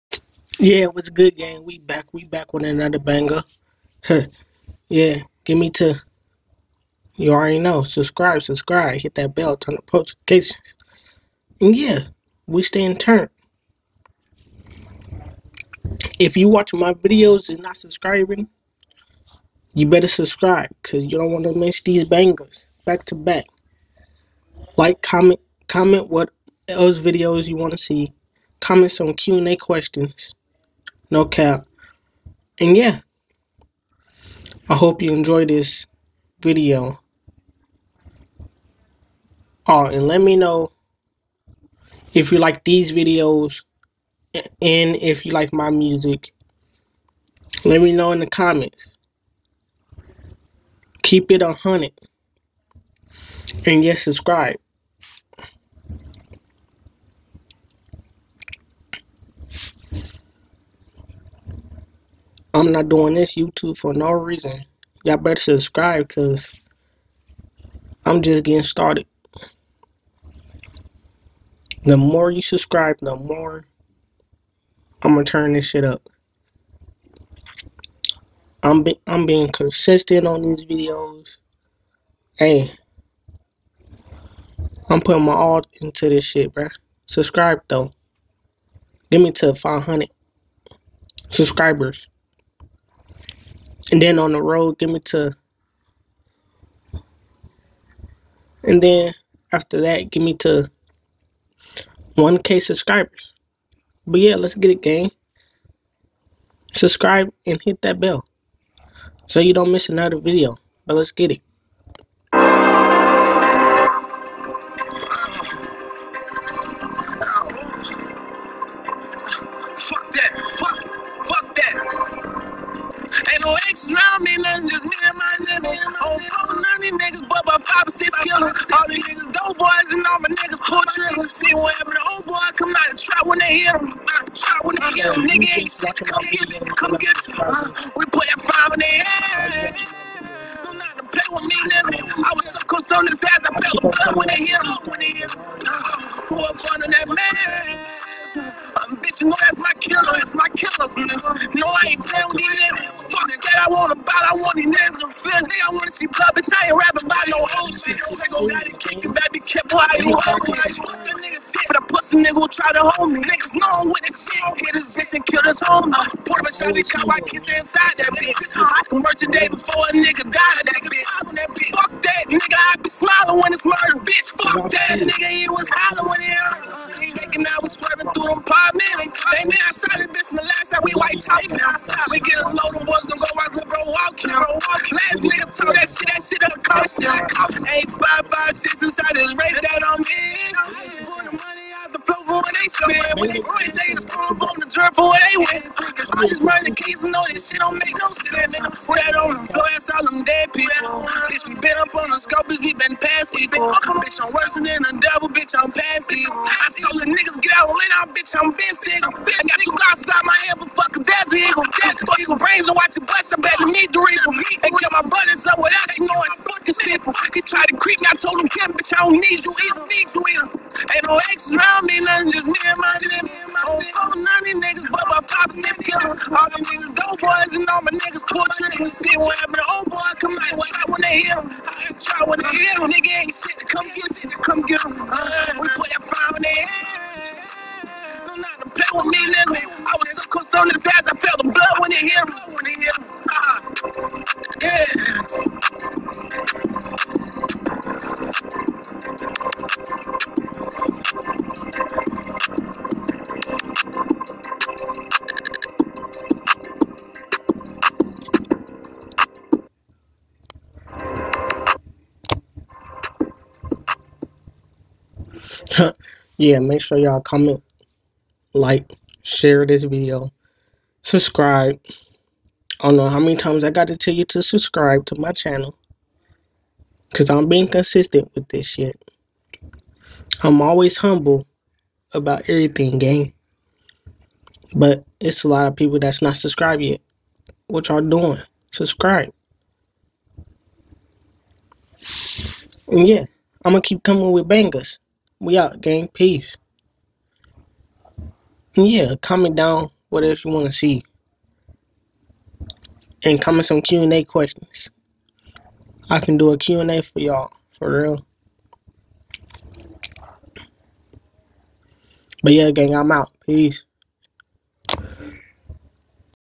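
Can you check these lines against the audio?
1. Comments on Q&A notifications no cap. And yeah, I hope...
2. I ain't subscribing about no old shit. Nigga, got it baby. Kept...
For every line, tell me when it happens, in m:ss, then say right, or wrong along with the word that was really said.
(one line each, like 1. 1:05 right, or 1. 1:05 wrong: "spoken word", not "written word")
1. 0:28 wrong: "questions", not "notifications"
2. 2:36 wrong: "rapping", not "subscribing".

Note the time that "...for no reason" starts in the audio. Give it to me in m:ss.
1:03.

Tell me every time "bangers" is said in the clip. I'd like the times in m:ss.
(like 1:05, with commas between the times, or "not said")
0:02, 0:22, 4:54.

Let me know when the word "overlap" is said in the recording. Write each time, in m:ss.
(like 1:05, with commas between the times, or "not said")
not said.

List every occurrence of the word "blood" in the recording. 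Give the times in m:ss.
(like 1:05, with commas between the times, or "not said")
2:23, 2:36, 4:01.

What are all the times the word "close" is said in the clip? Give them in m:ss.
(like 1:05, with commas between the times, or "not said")
2:22, 4:00.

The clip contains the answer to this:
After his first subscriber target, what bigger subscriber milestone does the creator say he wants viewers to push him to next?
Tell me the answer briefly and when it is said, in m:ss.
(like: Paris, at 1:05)
1K, at 1:42.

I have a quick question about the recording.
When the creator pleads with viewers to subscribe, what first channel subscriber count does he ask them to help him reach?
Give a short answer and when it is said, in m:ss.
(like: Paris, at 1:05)
500, at 1:29.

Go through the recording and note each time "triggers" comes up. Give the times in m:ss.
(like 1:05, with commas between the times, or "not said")
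2:10, 3:48.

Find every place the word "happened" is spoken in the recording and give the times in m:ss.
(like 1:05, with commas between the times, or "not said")
2:11, 3:49.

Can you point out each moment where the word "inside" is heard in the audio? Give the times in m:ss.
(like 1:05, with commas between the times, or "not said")
2:47, 3:08.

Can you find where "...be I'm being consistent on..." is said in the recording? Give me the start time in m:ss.
1:18.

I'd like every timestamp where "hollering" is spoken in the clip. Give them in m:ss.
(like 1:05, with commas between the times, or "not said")
2:55.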